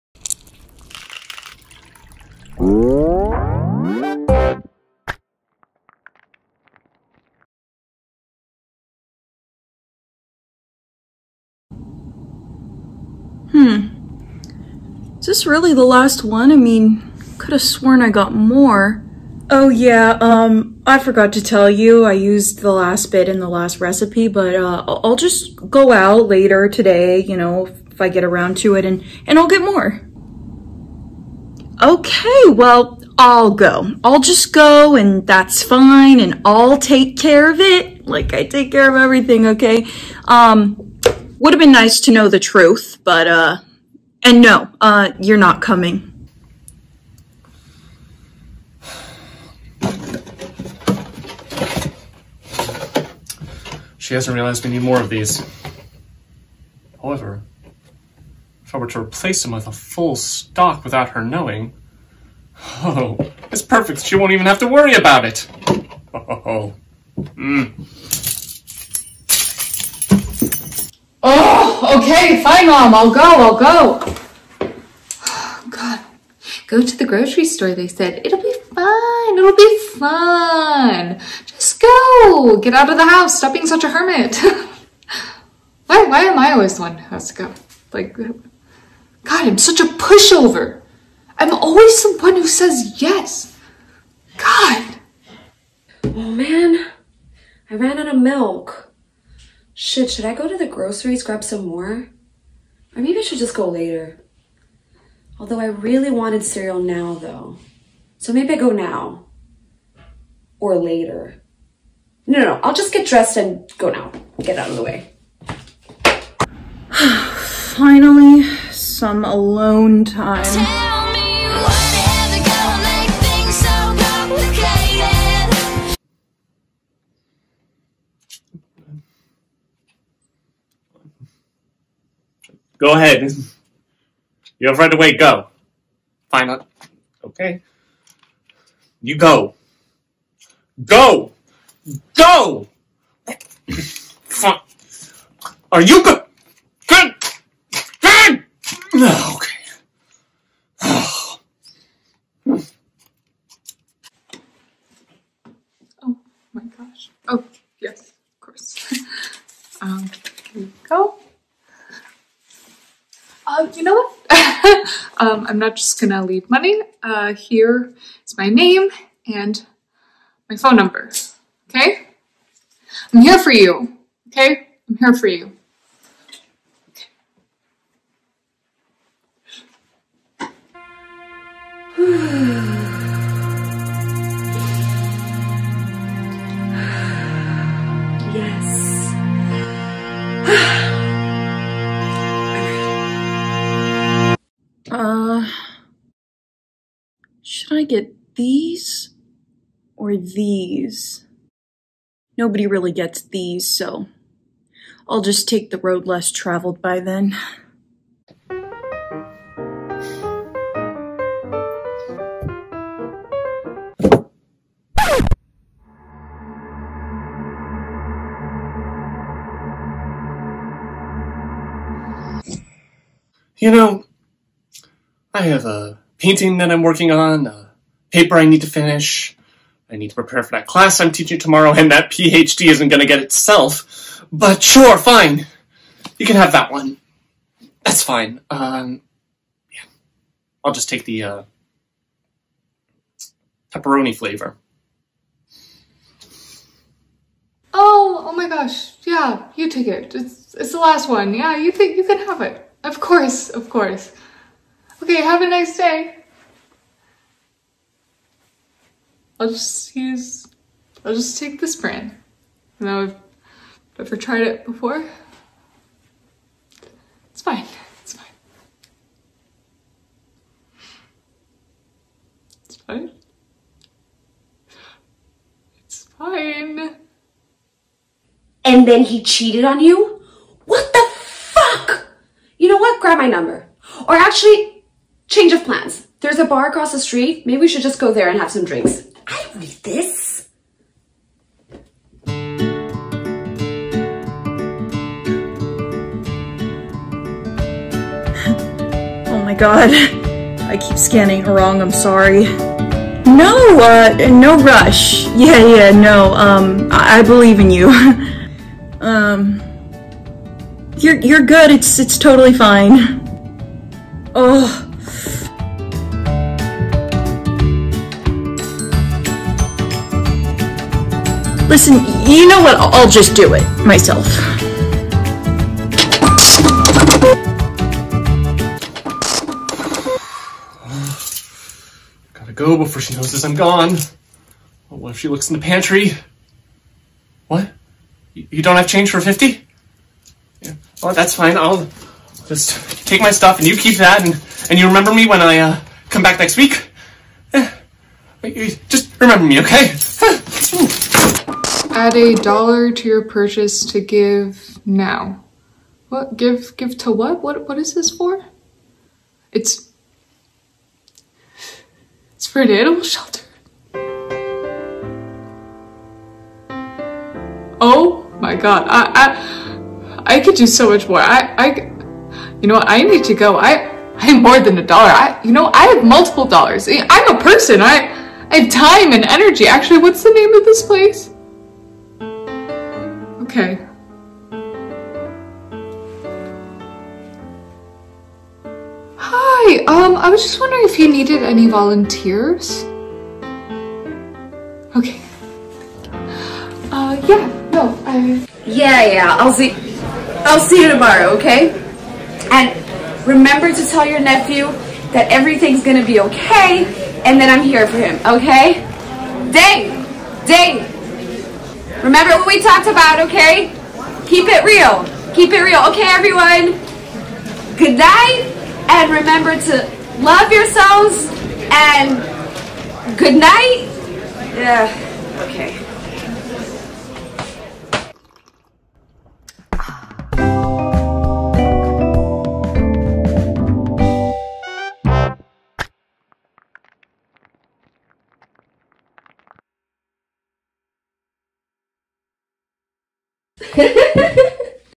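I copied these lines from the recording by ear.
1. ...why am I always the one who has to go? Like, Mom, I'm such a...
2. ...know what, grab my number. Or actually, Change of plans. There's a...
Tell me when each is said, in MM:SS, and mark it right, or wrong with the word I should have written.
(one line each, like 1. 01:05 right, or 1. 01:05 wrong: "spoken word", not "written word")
1. 01:26 wrong: "God", not "Mom"
2. 04:42 right.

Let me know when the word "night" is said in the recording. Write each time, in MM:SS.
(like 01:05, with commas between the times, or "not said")
06:57, 07:03.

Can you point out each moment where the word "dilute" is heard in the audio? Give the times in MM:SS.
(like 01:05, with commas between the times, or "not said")
not said.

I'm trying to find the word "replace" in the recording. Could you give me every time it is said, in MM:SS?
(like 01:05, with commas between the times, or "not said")
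00:58.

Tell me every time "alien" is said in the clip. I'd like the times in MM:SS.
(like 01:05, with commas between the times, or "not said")
not said.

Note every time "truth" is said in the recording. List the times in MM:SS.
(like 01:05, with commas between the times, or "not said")
00:42.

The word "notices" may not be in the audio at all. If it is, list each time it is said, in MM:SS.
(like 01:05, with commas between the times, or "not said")
05:33.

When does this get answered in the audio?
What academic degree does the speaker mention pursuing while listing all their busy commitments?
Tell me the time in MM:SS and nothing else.
03:52.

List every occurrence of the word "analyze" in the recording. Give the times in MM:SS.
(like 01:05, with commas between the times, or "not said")
not said.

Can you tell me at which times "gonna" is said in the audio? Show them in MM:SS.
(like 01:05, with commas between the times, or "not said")
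02:46, 06:45.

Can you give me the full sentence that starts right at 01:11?
okay, fine, Mom, I'll go, I'll go.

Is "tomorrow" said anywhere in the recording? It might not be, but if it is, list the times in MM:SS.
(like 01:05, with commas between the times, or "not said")
03:51, 06:40.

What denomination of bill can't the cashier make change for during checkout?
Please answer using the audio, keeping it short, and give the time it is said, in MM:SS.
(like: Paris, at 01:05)
50, at 05:39.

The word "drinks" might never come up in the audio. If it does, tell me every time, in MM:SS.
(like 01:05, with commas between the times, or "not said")
04:48.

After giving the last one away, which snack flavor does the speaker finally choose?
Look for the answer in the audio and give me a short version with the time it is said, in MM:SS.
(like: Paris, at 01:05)
pepperoni, at 04:03.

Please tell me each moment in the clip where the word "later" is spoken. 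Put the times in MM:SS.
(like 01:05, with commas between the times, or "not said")
00:26, 01:43, 01:50.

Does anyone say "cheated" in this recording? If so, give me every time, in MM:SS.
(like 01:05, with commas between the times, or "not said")
04:39.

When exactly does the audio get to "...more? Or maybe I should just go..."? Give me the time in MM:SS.
01:41.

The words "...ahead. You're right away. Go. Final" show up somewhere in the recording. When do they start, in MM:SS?
02:12.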